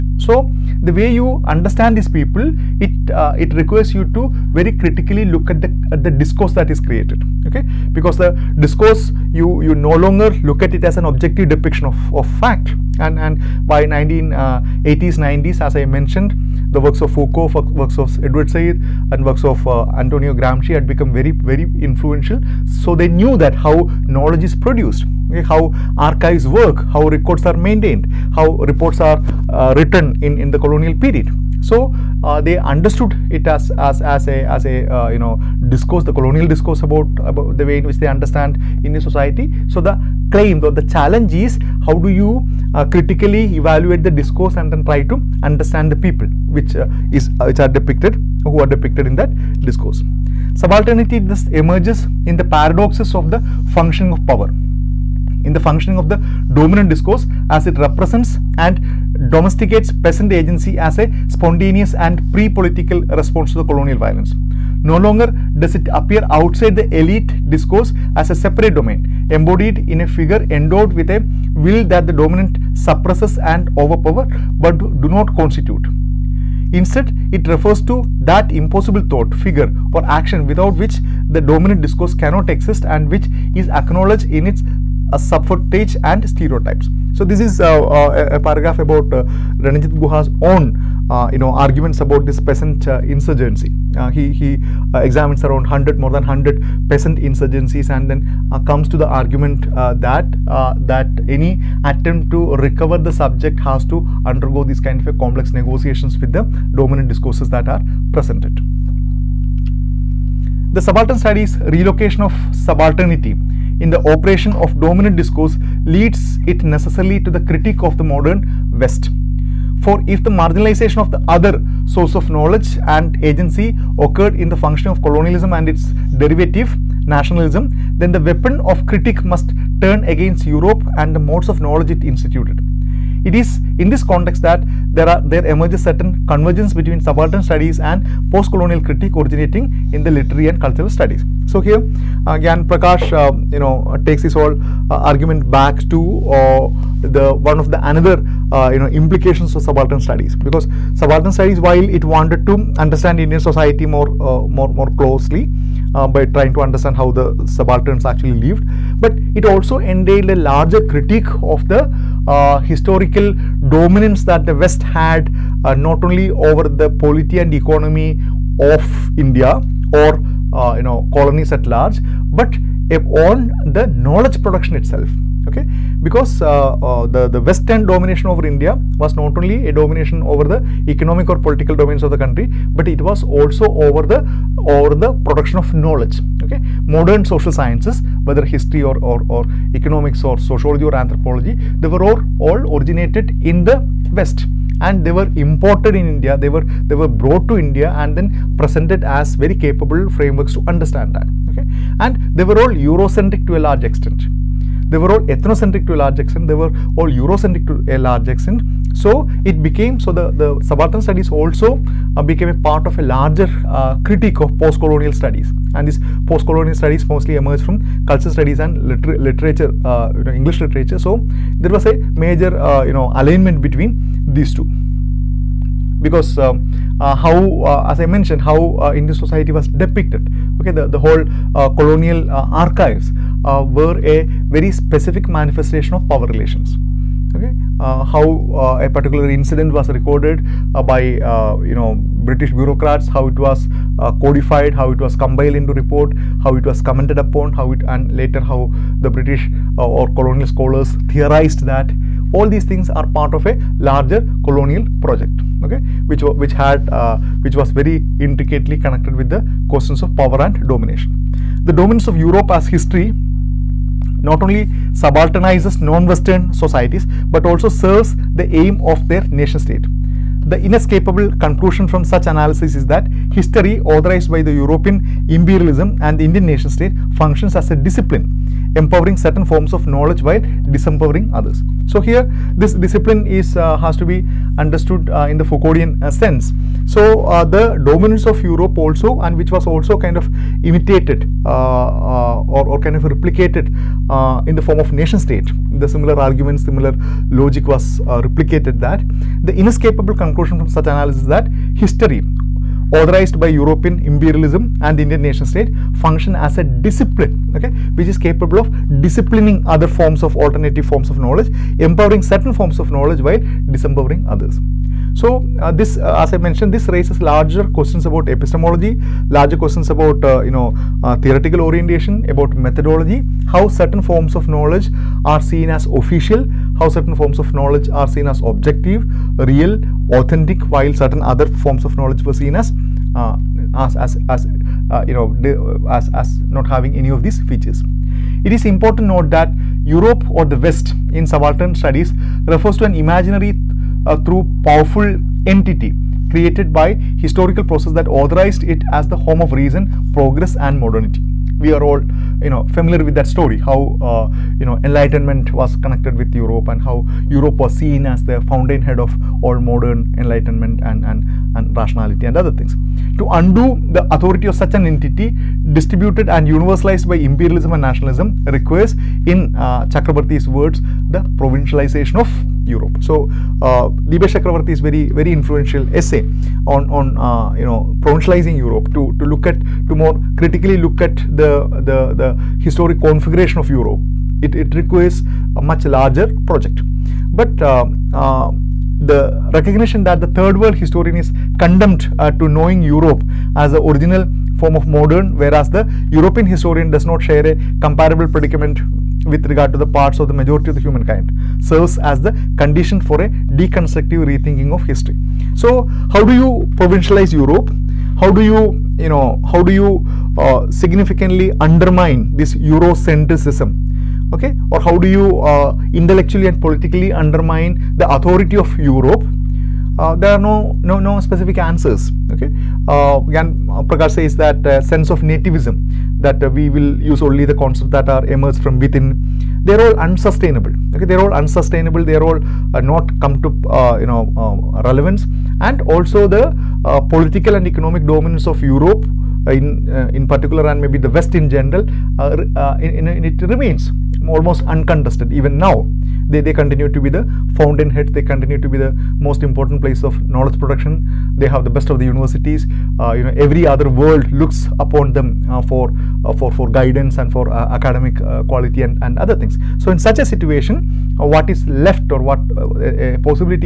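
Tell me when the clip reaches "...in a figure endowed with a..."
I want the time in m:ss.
1:09.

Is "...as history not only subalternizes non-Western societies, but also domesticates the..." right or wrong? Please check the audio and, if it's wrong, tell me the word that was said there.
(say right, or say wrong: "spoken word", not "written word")
wrong: "serves", not "domesticates".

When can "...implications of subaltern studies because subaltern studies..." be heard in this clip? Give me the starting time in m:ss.
2:29.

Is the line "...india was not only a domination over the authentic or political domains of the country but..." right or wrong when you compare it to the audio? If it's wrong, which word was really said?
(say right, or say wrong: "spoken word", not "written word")
wrong: "economic", not "authentic".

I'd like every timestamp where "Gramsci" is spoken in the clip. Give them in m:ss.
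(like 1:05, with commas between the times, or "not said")
0:20.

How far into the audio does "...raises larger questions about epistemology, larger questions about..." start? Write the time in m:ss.
5:16.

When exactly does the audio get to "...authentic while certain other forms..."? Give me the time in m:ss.
5:30.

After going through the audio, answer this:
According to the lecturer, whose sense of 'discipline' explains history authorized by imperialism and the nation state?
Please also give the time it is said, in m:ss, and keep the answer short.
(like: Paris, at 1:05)
Foucauldian, at 4:45.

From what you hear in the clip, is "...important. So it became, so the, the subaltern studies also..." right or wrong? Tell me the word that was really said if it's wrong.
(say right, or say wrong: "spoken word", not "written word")
wrong: "extent", not "important".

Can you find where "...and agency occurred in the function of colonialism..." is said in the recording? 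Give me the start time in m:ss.
2:02.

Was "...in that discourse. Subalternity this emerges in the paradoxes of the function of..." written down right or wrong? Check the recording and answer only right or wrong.
right.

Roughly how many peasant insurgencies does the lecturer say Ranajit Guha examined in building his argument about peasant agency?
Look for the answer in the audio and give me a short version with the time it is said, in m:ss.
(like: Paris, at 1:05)
more than 100, at 1:35.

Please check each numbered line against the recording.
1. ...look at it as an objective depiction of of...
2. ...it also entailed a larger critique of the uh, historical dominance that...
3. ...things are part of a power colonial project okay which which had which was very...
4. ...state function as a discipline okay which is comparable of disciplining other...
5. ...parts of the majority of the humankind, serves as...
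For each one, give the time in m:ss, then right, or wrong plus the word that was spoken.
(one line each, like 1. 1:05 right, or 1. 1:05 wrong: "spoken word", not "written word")
1. 0:10 right
2. 2:39 right
3. 4:12 wrong: "larger", not "power"
4. 5:05 wrong: "capable", not "comparable"
5. 6:39 right.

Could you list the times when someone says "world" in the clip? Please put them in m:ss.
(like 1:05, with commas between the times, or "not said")
6:30, 7:33.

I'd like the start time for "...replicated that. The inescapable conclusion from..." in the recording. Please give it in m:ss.
4:58.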